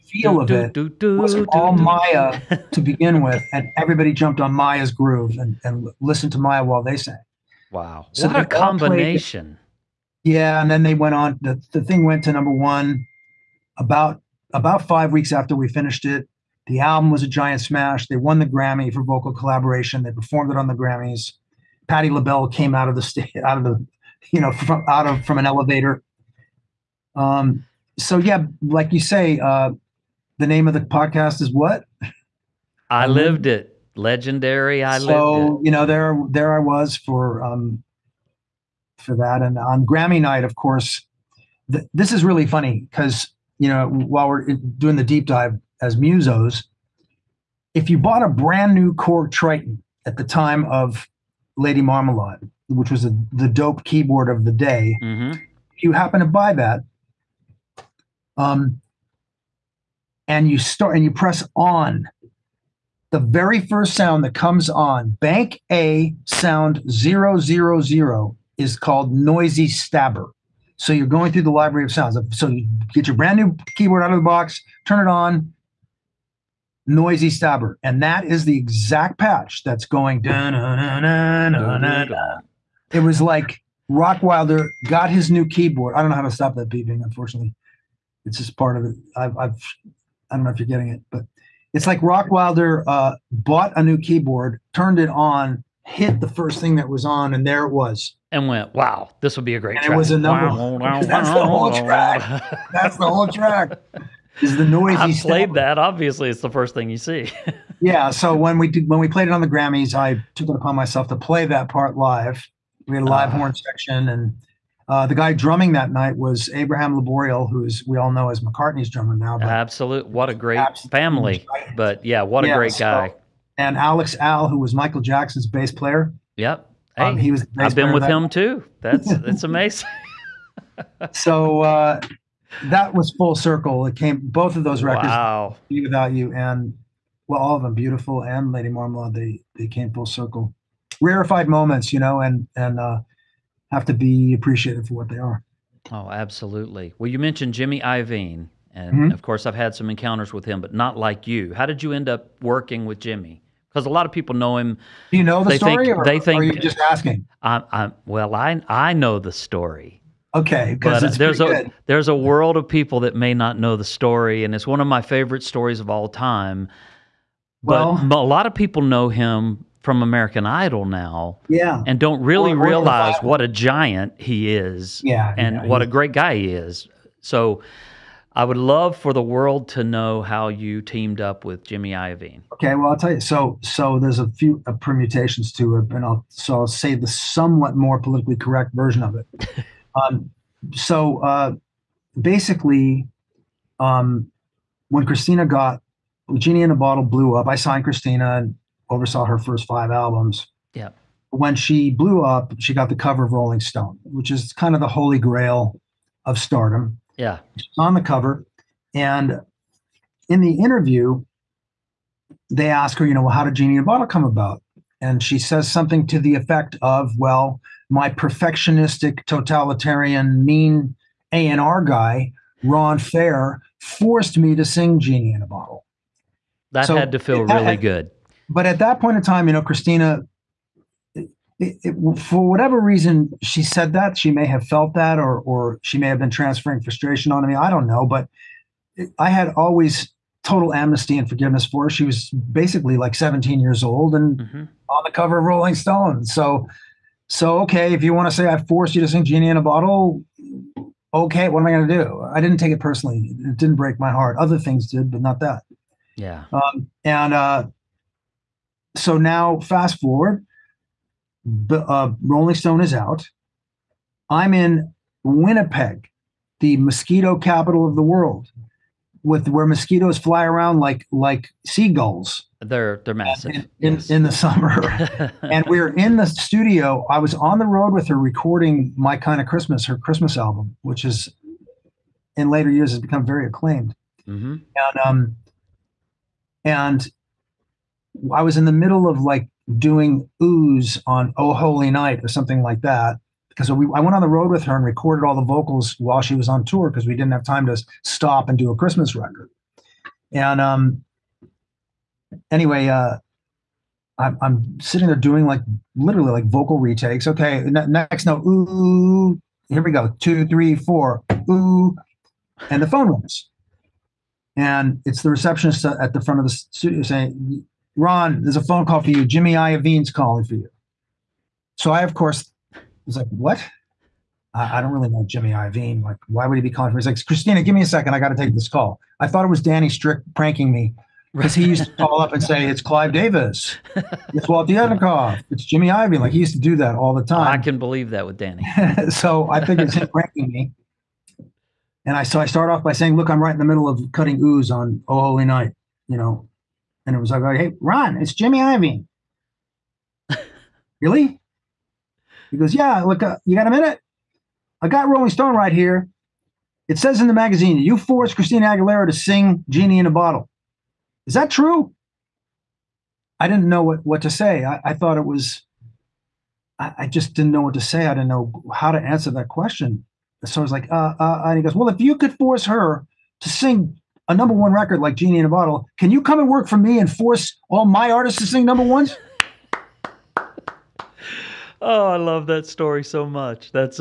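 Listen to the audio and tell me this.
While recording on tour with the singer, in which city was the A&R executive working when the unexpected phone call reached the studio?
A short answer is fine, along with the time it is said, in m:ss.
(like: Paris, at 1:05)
Winnipeg, at 4:25.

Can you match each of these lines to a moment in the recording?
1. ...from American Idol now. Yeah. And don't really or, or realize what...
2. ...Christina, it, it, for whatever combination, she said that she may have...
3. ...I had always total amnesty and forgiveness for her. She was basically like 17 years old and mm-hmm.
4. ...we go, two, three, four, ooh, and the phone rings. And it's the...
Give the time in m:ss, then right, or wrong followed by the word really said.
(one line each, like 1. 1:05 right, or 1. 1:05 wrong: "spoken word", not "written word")
1. 2:49 right
2. 3:49 wrong: "reason", not "combination"
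3. 3:59 right
4. 5:09 right.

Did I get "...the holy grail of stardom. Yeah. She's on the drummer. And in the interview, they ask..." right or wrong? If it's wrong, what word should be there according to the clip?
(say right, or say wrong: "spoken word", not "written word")
wrong: "cover", not "drummer".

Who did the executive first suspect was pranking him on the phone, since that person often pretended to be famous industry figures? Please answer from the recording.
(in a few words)
Danny Strick.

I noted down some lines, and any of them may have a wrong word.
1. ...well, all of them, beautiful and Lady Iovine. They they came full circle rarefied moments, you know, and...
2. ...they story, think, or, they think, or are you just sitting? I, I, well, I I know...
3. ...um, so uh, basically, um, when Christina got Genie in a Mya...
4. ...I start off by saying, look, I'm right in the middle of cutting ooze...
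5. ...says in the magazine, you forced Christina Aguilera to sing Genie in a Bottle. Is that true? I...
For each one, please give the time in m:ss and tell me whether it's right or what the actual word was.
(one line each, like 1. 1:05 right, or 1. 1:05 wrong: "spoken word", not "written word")
1. 2:17 wrong: "Marmalade", not "Iovine"
2. 2:35 wrong: "asking", not "sitting"
3. 3:10 wrong: "Bottle", not "Mya"
4. 5:42 right
5. 5:56 right.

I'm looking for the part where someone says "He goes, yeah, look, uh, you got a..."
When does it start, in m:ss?
5:52.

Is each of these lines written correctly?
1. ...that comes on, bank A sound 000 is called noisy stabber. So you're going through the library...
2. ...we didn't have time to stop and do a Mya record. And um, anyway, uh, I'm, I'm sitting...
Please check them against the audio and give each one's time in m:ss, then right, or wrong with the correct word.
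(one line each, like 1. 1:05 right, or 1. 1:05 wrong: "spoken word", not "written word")
1. 1:04 right
2. 4:57 wrong: "Christmas", not "Mya".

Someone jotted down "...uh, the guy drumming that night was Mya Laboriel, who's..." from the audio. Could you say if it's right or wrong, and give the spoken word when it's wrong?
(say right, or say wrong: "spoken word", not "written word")
wrong: "Abraham", not "Mya".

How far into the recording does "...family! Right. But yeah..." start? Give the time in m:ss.
2:00.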